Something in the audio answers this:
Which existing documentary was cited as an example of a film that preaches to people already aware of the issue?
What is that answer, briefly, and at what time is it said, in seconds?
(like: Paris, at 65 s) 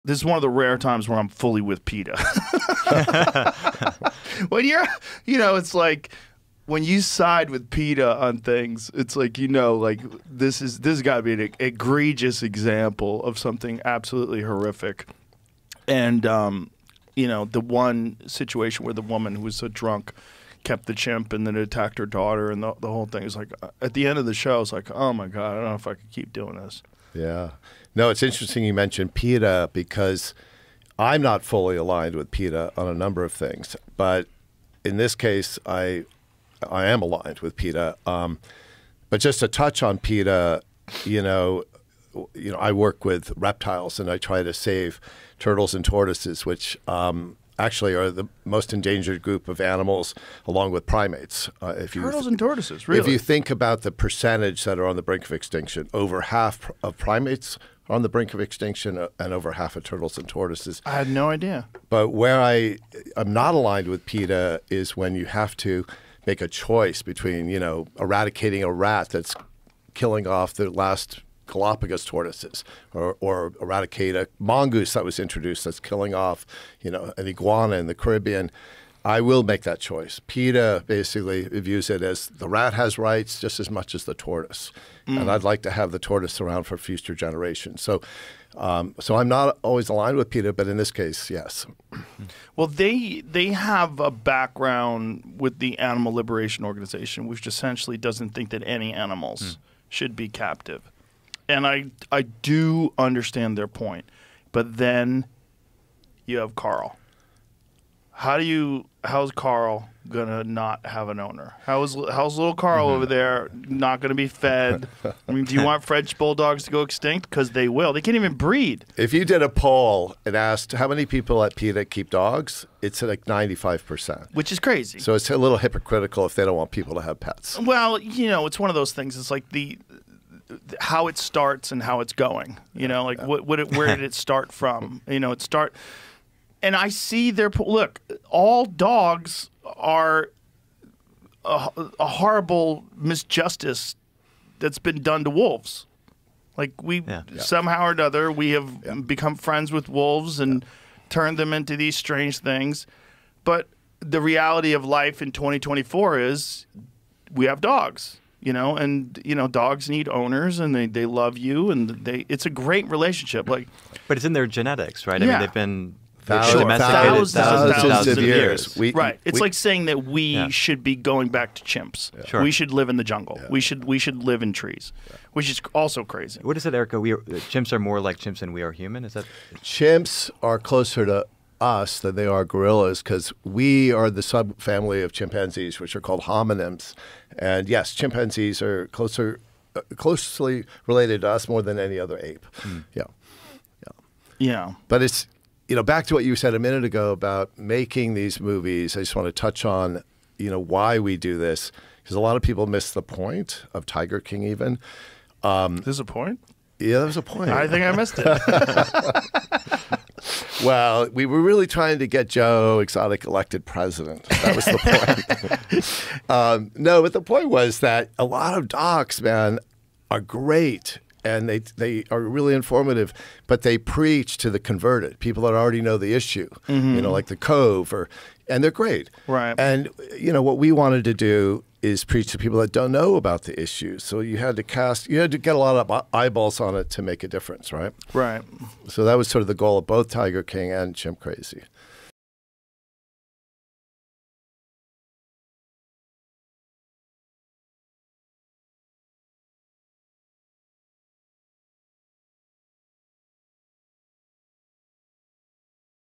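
The Cove, at 227 s.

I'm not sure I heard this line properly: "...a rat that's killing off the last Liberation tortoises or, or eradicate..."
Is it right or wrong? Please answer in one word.
wrong.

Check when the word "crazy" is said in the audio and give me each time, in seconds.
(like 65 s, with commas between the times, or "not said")
124 s, 176 s, 241 s.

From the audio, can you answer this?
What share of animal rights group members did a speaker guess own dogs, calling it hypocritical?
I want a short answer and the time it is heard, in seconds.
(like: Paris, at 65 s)
95%, at 123 s.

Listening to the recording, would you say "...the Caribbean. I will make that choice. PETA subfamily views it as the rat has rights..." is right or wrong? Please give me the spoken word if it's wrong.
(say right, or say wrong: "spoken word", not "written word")
wrong: "basically", not "subfamily".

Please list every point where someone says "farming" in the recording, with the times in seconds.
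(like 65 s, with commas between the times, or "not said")
not said.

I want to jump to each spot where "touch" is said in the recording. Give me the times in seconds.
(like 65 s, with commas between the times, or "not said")
39 s, 199 s.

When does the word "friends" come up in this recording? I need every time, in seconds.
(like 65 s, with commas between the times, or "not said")
149 s.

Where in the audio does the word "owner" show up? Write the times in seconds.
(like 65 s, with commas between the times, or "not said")
111 s, 160 s.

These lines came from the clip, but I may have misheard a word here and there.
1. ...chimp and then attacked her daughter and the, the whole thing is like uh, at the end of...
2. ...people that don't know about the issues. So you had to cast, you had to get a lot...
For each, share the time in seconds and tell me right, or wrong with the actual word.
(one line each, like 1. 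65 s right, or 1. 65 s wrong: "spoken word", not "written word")
1. 20 s right
2. 232 s right.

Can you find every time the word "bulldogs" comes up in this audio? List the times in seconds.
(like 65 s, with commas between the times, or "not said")
116 s.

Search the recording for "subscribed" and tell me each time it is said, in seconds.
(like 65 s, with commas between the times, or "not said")
not said.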